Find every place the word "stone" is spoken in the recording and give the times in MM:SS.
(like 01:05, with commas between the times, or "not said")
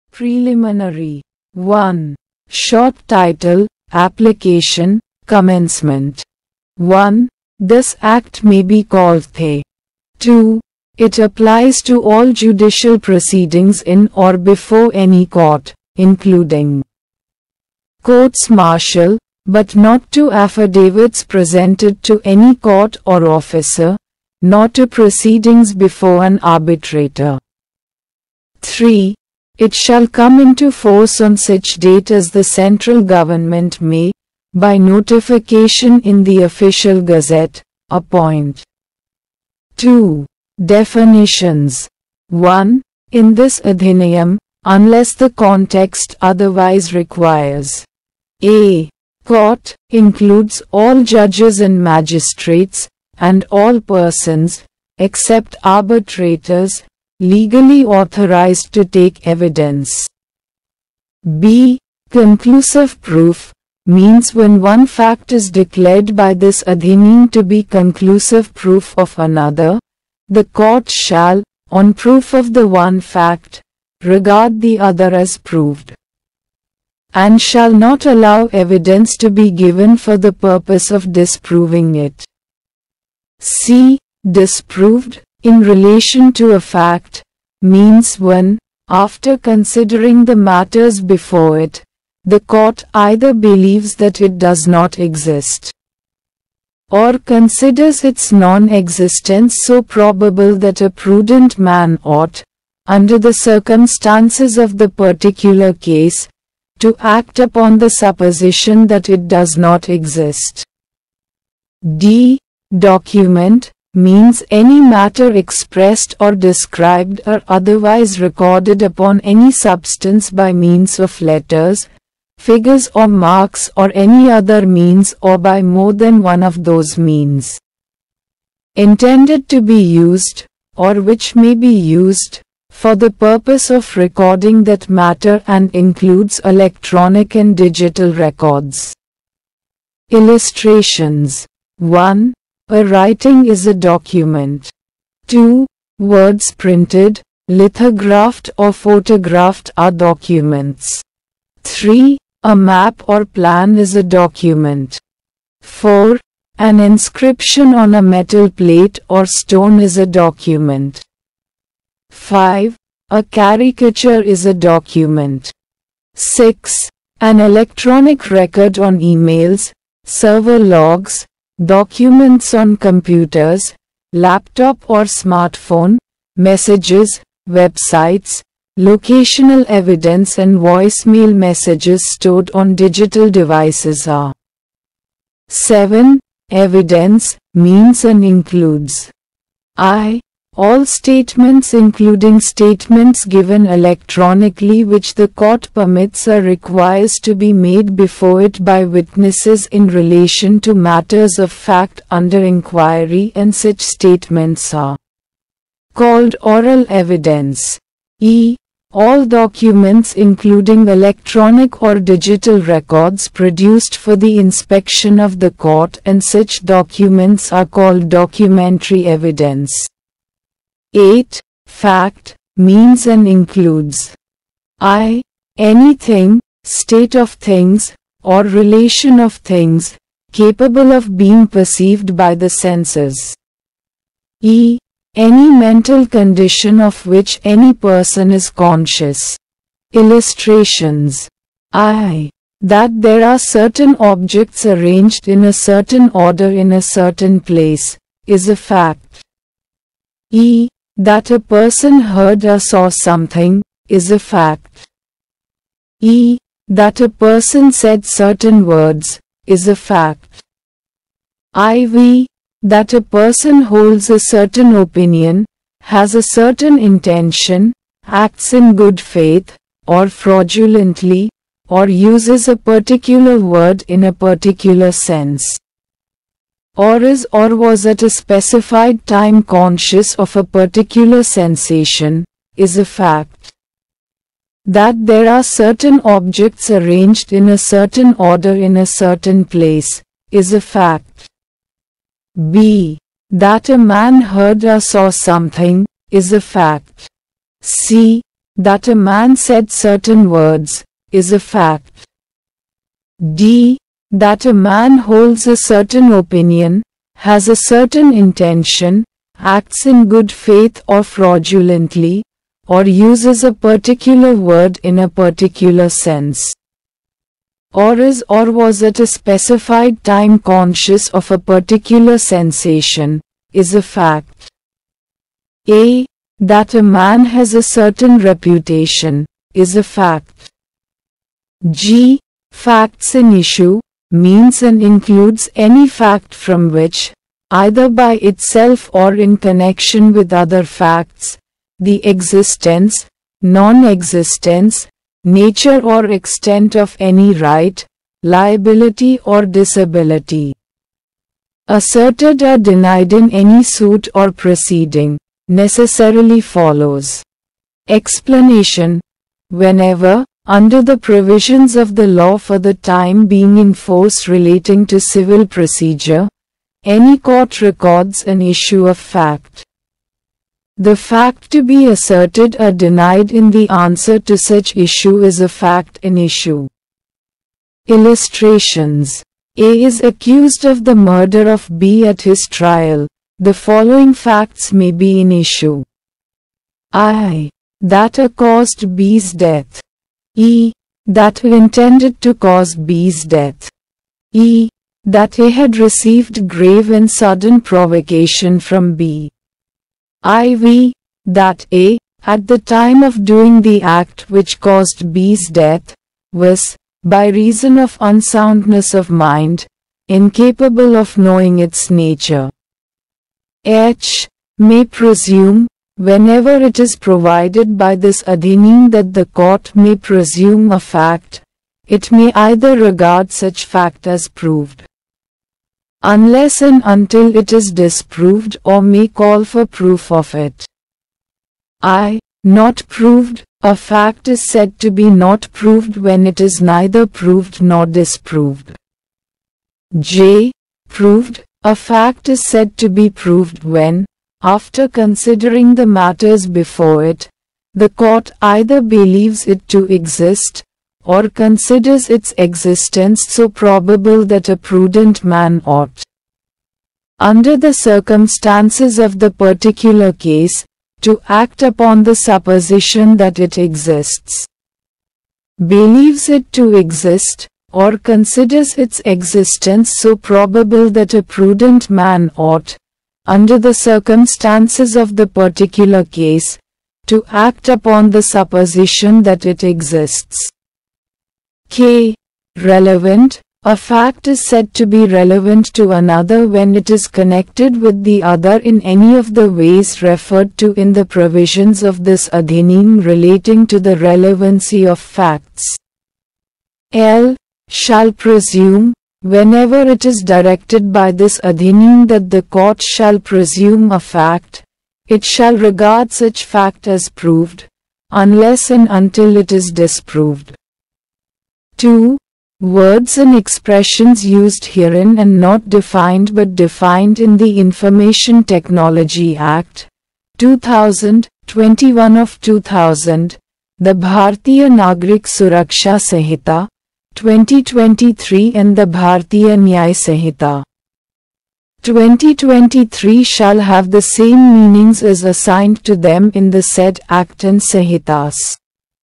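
02:39.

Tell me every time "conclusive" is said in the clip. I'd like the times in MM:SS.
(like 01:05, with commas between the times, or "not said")
01:02, 01:07.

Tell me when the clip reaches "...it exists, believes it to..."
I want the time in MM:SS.
07:43.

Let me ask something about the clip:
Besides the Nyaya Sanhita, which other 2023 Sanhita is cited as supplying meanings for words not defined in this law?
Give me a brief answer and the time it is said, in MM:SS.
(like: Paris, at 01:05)
Bharatiya Nagrik Suraksha Sanhita, at 08:43.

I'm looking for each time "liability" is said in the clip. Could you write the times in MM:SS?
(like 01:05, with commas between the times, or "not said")
05:48.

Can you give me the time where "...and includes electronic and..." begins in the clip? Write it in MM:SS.
02:15.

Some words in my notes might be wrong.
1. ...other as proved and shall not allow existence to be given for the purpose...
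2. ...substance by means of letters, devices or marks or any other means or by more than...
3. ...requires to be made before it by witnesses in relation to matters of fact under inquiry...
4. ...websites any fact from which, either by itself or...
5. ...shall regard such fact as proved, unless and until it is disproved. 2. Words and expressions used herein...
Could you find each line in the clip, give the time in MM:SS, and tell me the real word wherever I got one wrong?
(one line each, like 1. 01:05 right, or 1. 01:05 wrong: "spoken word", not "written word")
1. 01:14 wrong: "evidence", not "existence"
2. 01:59 wrong: "figures", not "devices"
3. 03:16 right
4. 05:34 wrong: "includes", not "websites"
5. 08:25 right.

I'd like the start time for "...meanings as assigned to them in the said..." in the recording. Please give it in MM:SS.
08:54.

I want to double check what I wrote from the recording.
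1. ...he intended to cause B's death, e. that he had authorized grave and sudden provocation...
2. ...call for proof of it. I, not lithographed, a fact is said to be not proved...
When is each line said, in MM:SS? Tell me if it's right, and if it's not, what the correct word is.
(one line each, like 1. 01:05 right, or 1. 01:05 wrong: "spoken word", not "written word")
1. 06:31 wrong: "received", not "authorized"
2. 07:09 wrong: "proved", not "lithographed".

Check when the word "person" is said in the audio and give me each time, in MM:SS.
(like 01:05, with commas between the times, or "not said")
00:53, 03:57, 04:11, 04:17, 04:22.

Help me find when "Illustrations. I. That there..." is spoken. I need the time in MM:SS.
03:59.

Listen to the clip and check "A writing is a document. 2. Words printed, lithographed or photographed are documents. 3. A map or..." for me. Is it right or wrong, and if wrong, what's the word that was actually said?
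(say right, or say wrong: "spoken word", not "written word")
right.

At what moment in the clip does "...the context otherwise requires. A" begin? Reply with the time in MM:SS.
00:45.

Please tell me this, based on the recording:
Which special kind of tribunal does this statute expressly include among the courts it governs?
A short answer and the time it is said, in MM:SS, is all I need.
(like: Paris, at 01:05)
courts martial, at 00:18.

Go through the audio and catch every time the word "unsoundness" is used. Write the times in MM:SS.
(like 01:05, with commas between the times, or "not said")
06:47.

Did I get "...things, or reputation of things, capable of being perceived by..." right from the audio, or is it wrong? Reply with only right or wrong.
wrong.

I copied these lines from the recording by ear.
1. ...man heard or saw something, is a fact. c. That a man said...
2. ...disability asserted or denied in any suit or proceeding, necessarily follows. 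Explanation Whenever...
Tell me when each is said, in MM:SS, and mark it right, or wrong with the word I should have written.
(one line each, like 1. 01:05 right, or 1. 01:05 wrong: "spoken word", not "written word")
1. 04:53 right
2. 05:49 right.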